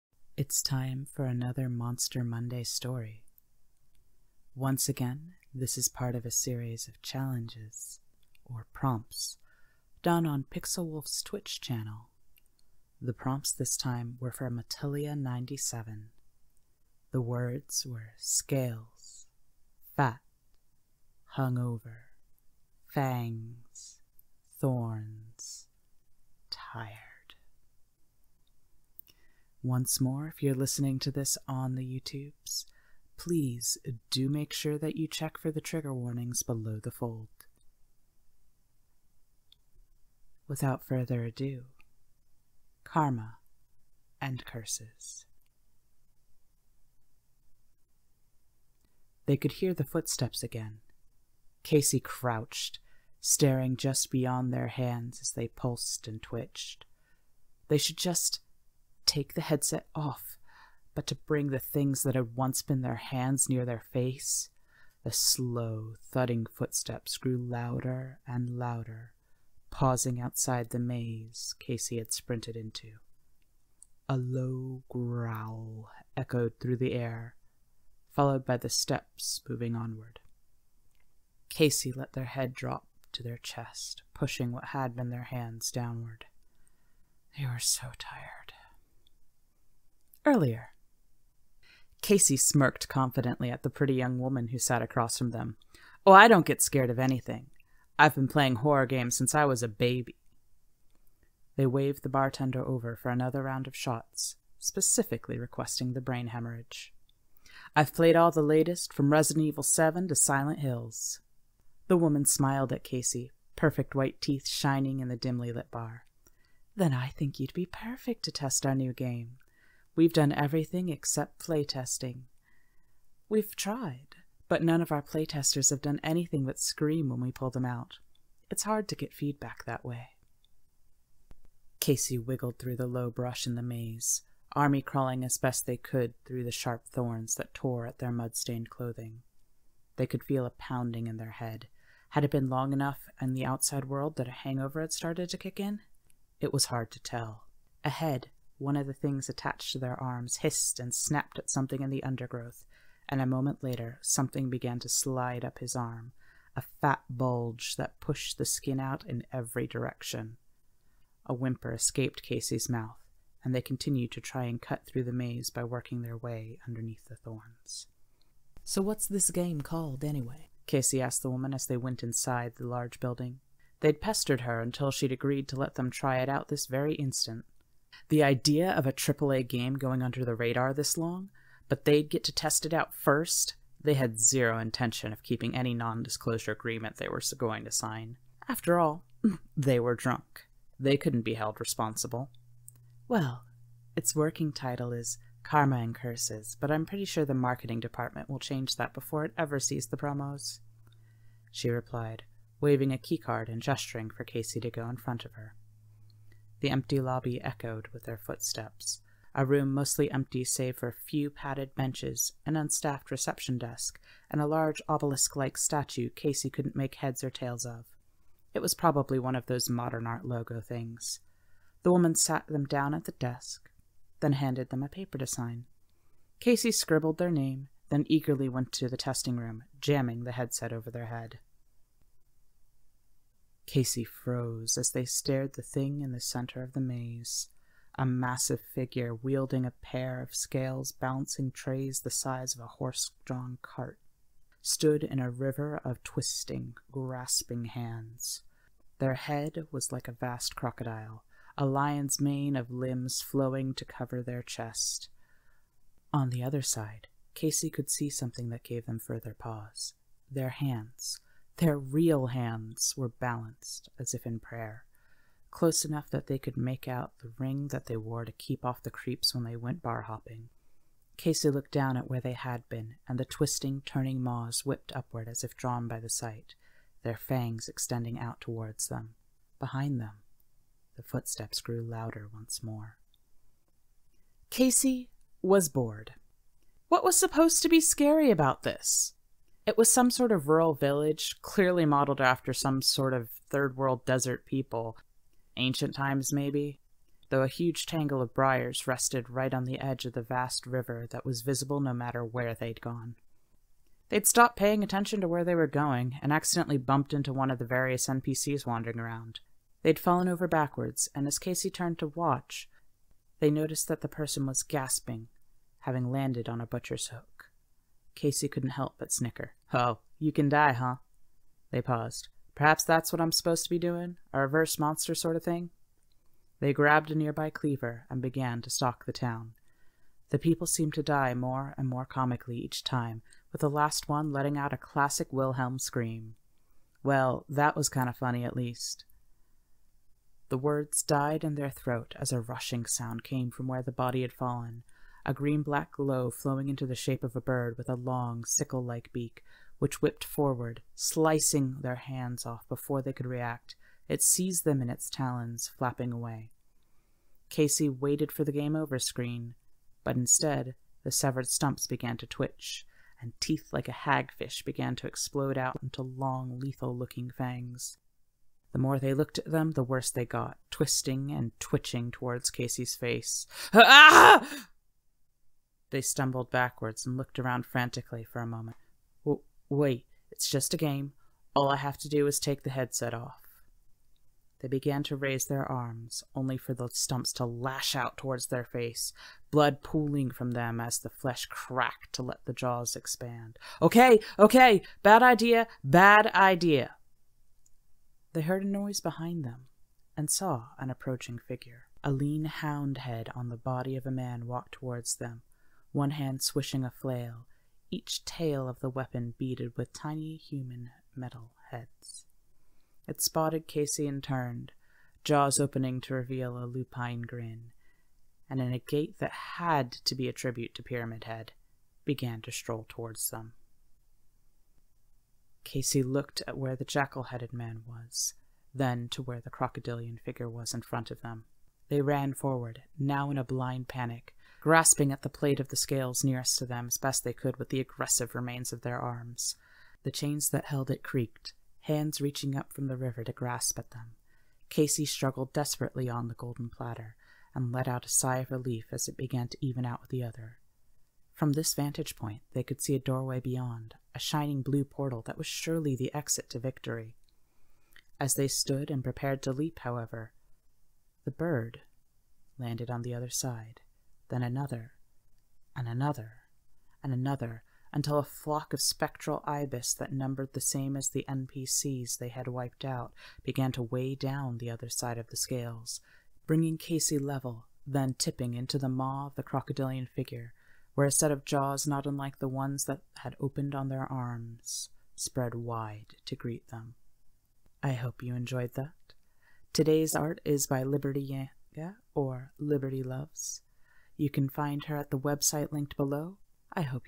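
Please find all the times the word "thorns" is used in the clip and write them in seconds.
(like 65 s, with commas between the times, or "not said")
24 s, 136 s, 167 s.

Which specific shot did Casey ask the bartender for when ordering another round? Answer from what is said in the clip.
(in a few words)
brain hemorrhage.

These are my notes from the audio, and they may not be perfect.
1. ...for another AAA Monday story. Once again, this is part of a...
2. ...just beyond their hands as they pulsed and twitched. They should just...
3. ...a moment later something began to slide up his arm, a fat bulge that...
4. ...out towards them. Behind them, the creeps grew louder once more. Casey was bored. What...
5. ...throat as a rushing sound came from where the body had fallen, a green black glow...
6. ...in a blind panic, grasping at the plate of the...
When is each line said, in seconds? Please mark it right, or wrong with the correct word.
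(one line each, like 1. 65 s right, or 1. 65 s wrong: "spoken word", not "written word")
1. 1 s wrong: "Monster", not "AAA"
2. 53 s right
3. 153 s right
4. 278 s wrong: "footsteps", not "creeps"
5. 341 s right
6. 433 s right.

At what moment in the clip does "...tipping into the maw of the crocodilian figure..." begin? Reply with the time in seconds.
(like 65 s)
478 s.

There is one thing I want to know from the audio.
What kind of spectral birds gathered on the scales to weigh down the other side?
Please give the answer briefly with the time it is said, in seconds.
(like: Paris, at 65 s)
ibis, at 469 s.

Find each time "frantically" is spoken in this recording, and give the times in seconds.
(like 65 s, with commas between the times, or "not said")
377 s.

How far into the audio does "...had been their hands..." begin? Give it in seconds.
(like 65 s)
84 s.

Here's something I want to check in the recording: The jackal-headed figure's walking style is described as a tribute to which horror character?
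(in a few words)
Pyramid Head.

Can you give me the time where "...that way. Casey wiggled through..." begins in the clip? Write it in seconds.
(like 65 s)
129 s.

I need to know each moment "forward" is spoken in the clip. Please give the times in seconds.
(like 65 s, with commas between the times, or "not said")
350 s, 432 s.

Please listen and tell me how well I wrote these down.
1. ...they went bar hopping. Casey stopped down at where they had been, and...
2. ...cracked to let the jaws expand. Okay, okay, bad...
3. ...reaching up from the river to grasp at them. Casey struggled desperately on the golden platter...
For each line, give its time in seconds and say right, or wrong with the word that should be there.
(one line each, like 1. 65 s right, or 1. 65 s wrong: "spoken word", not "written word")
1. 269 s wrong: "looked", not "stopped"
2. 391 s right
3. 442 s right.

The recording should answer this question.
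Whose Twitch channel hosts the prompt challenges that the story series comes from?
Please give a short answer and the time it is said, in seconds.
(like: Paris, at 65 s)
Pixelwulllf, at 10 s.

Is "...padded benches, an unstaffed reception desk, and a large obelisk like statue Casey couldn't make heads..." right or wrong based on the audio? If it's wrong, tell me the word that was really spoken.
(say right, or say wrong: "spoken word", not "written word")
right.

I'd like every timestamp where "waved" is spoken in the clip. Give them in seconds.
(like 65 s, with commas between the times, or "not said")
101 s.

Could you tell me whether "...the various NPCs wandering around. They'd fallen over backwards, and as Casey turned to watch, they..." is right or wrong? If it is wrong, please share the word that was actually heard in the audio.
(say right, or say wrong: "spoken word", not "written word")
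right.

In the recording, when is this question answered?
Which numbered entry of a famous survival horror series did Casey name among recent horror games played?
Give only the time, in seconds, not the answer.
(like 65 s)
109 s.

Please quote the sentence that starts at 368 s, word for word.
The more they looked at them, the worse they got, twisting and twitching towards Casey's face.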